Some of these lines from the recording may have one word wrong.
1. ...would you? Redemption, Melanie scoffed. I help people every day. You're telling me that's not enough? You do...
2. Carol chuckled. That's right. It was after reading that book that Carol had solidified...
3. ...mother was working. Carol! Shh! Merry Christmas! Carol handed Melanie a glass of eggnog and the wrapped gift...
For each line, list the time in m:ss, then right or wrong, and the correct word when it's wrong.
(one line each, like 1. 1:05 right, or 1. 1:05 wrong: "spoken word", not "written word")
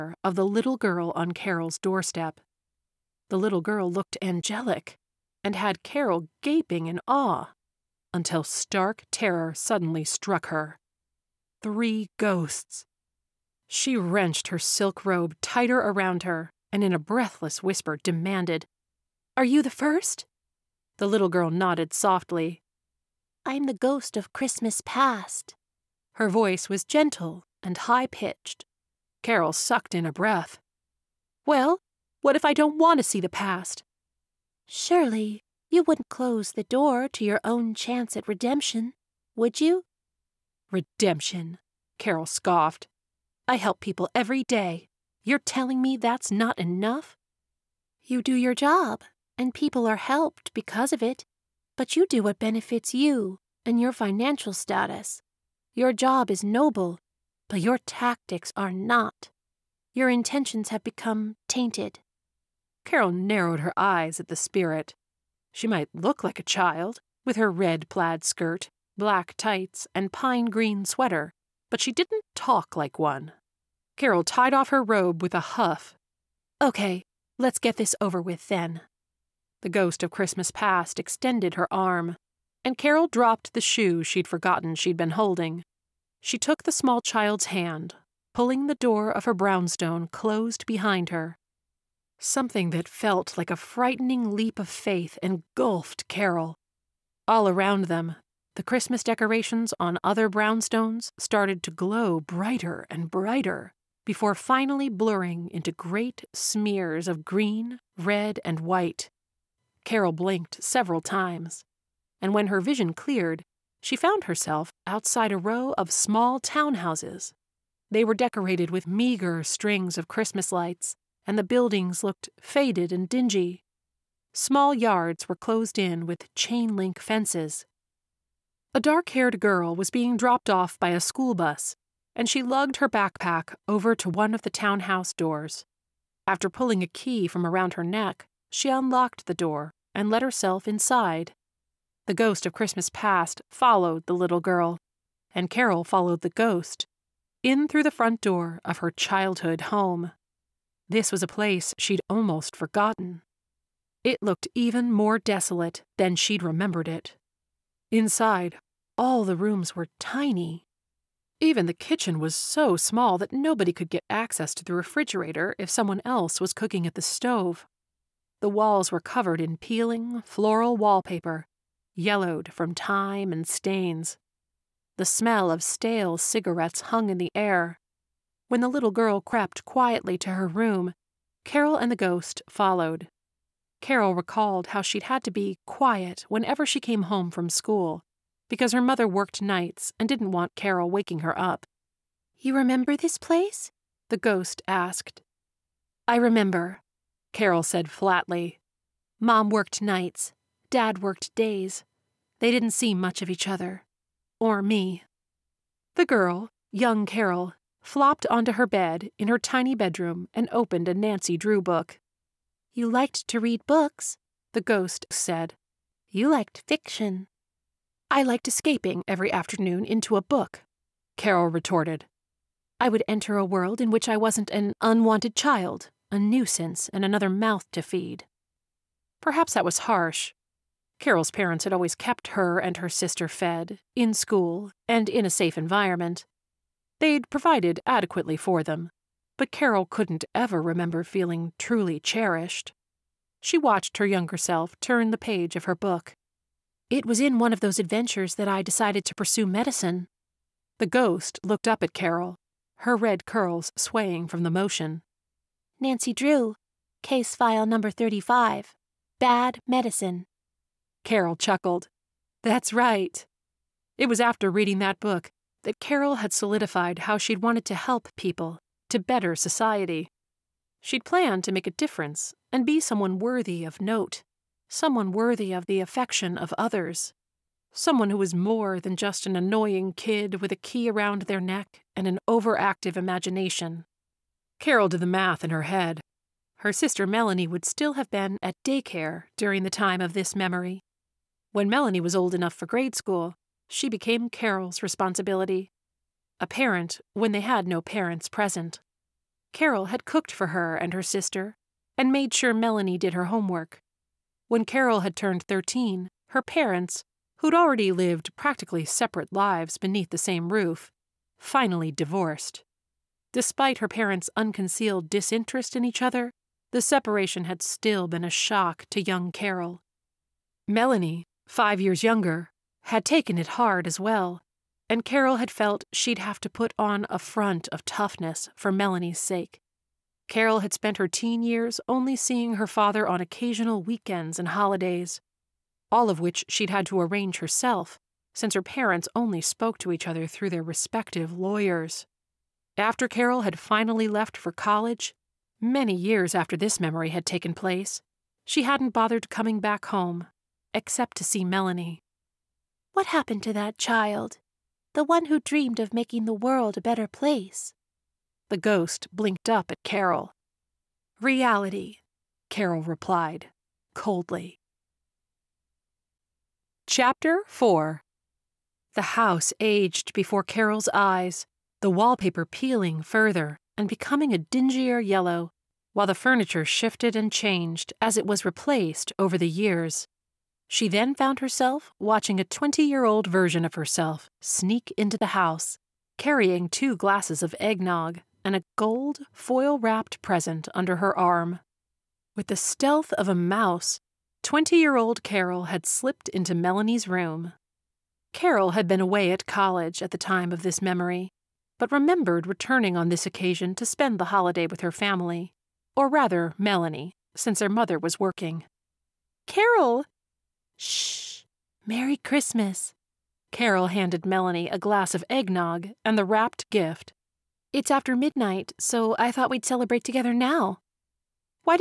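1. 0:39 wrong: "Carol", not "Melanie"
2. 4:21 right
3. 6:47 right.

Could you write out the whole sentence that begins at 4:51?
When Melanie was old enough for grade school, she became Carol's responsibility.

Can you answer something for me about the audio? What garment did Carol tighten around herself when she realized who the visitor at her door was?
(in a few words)
silk robe.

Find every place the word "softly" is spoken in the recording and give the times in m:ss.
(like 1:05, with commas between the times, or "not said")
0:21.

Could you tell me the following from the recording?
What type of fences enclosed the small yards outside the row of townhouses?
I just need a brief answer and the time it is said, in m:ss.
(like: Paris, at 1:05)
chain link, at 2:06.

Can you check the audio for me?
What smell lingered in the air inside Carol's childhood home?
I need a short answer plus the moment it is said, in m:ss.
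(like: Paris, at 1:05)
stale cigarettes, at 2:55.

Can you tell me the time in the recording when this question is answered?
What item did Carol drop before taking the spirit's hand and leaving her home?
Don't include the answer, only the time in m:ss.
1:23.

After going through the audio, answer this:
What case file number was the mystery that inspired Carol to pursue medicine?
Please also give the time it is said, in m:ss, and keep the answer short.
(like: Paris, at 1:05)
35, at 4:17.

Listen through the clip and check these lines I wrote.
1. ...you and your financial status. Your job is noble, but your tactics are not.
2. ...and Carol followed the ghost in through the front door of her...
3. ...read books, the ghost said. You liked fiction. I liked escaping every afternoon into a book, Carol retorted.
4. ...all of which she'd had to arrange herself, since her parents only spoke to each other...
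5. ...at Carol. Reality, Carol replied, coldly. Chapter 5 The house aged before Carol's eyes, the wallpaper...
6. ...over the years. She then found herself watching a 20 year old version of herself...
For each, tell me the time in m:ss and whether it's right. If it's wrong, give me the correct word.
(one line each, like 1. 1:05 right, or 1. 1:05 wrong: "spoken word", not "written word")
1. 0:52 right
2. 2:25 right
3. 3:33 right
4. 5:35 right
5. 5:59 wrong: "4", not "5"
6. 6:19 right.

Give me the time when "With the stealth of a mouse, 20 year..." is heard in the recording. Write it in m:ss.
6:32.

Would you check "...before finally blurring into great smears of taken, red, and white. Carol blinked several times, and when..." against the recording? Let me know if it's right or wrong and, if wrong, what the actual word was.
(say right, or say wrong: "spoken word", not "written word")
wrong: "green", not "taken".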